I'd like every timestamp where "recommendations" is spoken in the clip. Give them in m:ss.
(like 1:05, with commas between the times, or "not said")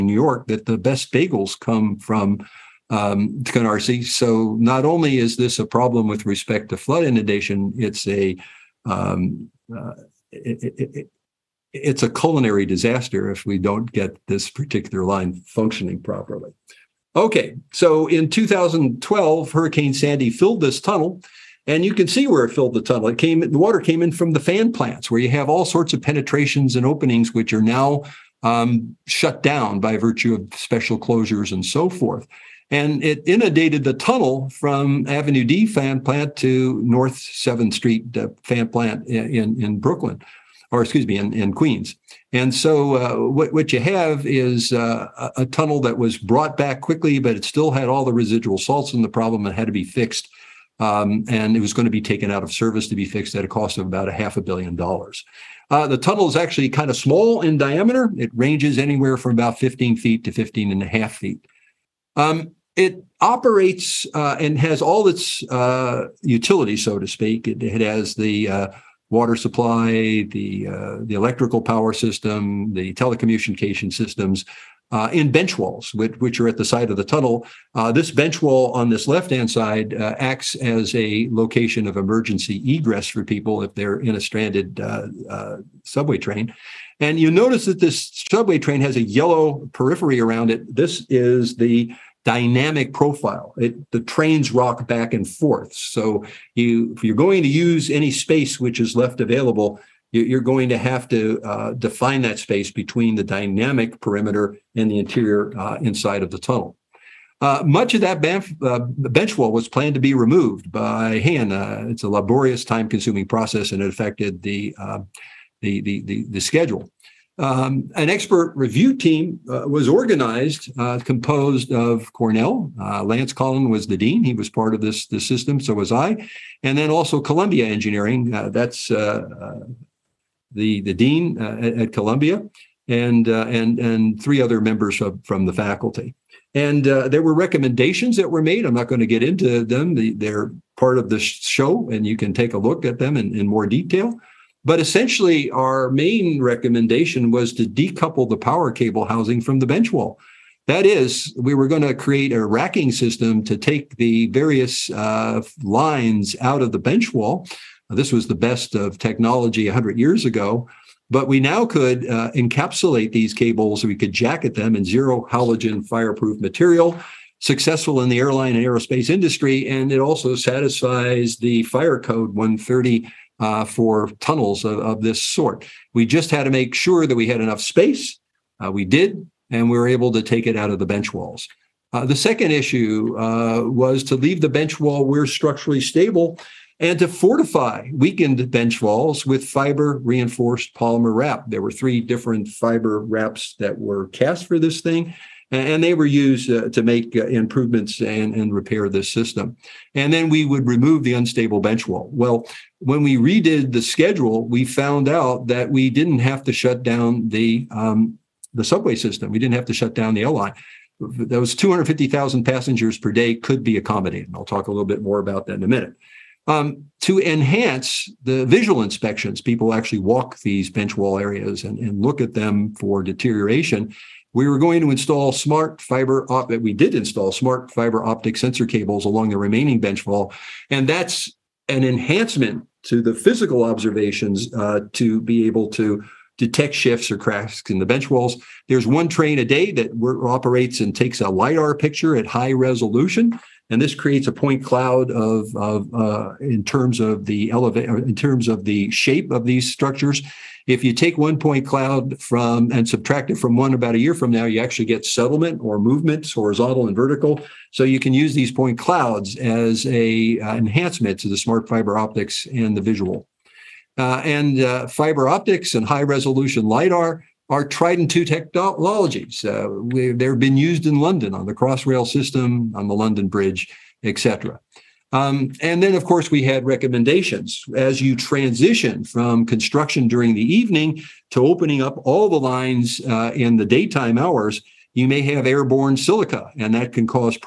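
2:17, 2:26, 4:36.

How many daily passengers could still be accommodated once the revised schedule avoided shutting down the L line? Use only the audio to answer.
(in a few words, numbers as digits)
250,000.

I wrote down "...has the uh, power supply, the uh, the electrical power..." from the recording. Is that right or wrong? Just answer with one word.
wrong.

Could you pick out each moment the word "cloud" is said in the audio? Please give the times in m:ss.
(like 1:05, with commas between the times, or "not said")
4:04, 4:11, 4:18.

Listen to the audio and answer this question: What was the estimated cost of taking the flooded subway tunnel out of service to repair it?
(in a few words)
half a billion dollars.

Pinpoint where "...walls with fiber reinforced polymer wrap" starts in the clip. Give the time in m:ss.
3:08.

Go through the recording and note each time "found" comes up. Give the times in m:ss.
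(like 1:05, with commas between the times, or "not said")
3:24.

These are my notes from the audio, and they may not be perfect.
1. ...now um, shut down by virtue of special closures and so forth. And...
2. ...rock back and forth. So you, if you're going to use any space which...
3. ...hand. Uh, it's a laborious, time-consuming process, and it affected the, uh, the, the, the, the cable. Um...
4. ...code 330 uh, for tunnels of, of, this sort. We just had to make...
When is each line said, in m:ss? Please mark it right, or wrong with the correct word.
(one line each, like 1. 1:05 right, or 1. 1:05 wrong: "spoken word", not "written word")
1. 0:27 right
2. 1:34 right
3. 1:51 wrong: "schedule", not "cable"
4. 2:51 wrong: "130", not "330".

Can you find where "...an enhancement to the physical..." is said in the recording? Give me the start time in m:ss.
3:51.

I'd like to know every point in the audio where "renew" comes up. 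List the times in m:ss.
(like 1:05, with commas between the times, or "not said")
not said.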